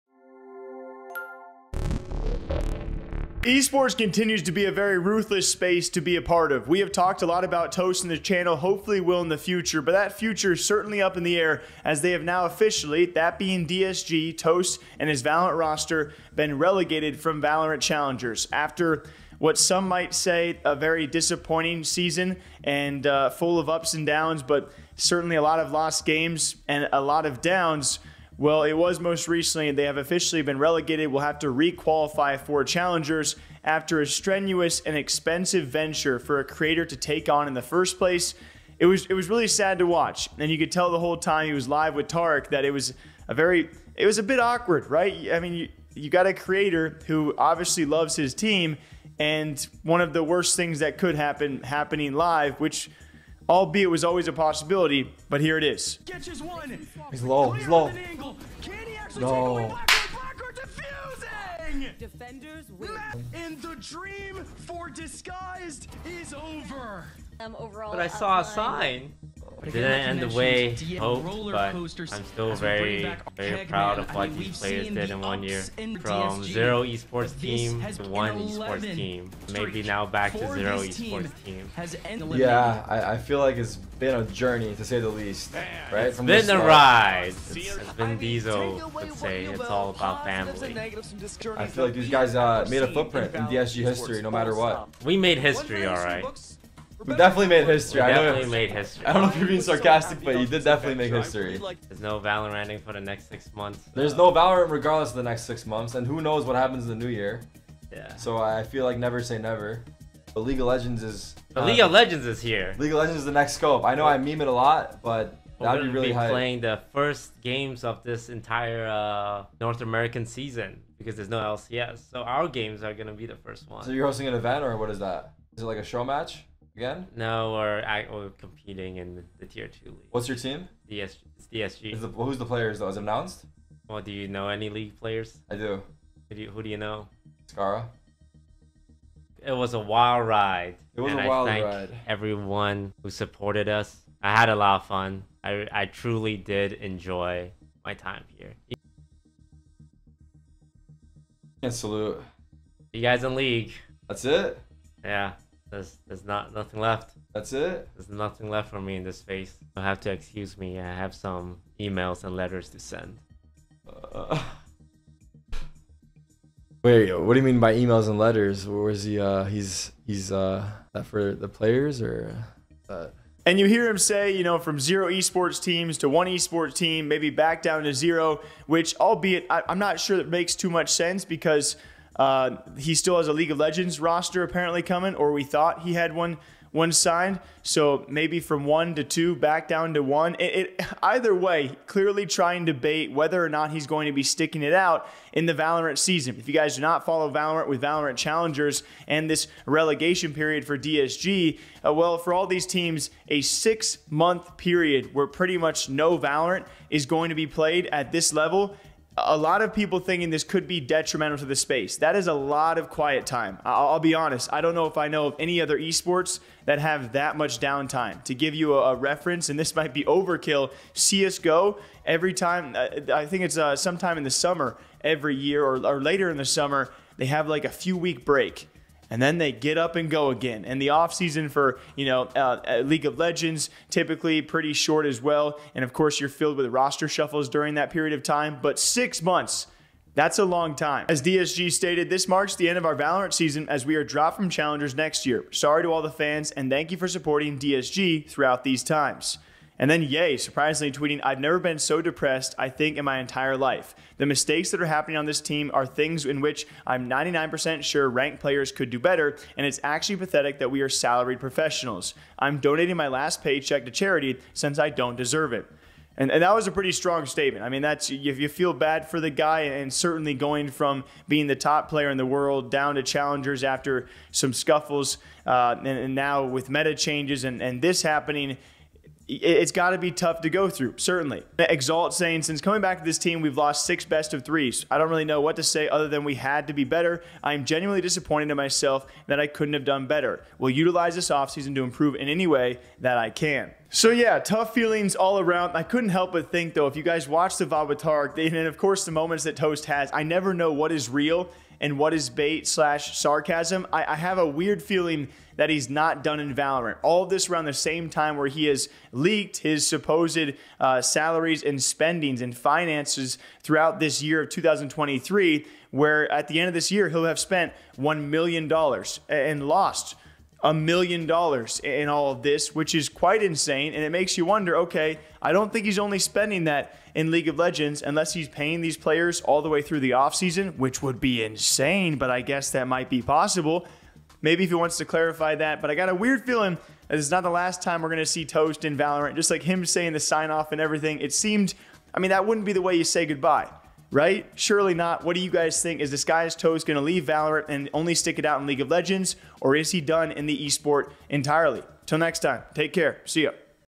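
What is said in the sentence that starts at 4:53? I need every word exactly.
So yeah, tough feelings all around.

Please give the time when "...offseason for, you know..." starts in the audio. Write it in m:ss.
3:50.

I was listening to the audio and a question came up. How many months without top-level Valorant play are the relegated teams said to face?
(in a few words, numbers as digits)
6.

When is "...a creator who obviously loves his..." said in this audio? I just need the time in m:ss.
0:46.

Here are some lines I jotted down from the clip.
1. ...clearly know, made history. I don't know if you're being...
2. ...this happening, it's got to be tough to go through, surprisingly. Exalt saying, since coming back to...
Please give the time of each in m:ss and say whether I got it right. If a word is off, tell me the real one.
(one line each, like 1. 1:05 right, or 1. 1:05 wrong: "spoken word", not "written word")
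1. 1:38 wrong: "definitely", not "clearly"
2. 4:37 wrong: "certainly", not "surprisingly".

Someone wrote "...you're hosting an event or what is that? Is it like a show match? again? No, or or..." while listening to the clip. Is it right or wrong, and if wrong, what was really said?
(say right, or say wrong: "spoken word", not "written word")
right.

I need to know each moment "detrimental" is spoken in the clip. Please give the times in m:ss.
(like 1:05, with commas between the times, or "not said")
3:30.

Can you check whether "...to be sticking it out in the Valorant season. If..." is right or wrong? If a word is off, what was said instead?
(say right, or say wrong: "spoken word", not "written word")
right.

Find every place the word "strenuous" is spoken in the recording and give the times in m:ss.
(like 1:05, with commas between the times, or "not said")
0:34.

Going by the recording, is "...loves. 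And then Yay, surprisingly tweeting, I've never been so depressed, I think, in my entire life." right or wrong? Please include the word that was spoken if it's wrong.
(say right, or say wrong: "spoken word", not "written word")
wrong: "times", not "loves".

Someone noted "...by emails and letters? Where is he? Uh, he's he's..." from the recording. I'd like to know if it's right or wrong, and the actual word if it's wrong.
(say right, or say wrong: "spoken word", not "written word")
right.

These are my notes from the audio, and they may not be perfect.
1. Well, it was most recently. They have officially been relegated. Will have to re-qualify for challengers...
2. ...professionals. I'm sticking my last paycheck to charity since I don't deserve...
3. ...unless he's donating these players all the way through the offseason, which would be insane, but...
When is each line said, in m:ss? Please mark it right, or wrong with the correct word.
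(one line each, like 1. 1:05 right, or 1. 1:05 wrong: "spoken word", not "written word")
1. 0:28 right
2. 4:21 wrong: "donating", not "sticking"
3. 5:28 wrong: "paying", not "donating".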